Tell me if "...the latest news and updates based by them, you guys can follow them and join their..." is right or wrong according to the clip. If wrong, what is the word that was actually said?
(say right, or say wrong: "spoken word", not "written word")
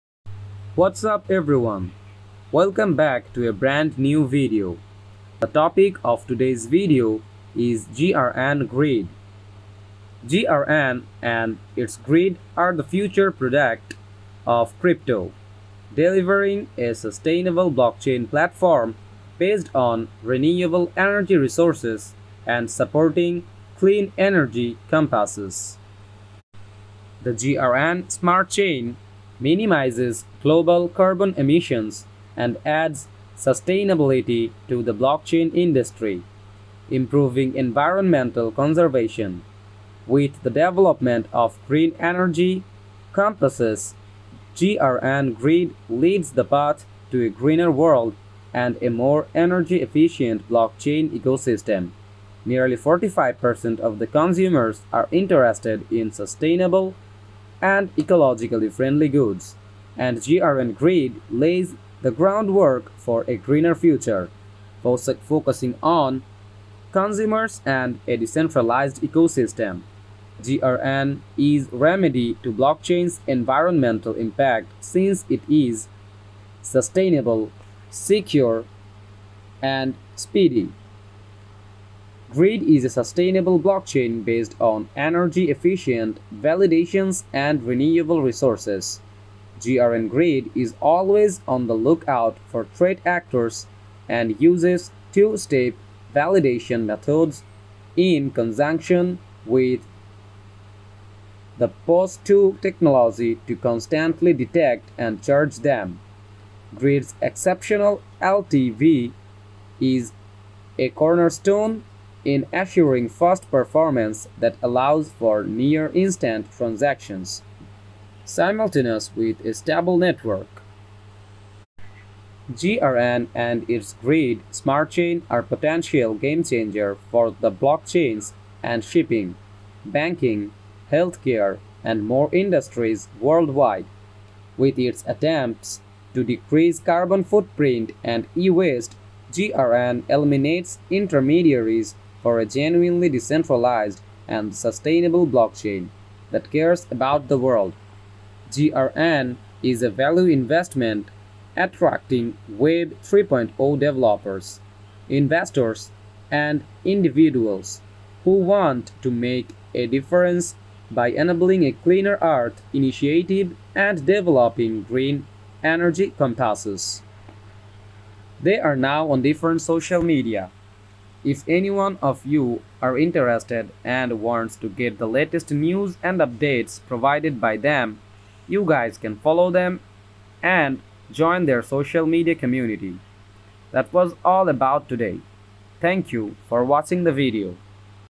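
wrong: "provided", not "based".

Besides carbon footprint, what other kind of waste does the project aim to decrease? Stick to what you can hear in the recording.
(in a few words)
e-waste.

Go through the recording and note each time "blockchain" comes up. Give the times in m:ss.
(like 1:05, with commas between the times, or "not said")
0:17, 0:34, 0:50, 1:12, 1:23, 2:07, 2:25.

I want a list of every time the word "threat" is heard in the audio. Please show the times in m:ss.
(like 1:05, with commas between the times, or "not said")
1:32.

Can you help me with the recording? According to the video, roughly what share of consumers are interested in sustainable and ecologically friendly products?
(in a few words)
45%.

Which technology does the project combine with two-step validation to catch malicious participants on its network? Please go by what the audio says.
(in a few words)
POS2.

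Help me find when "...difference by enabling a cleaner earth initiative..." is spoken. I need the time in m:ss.
2:39.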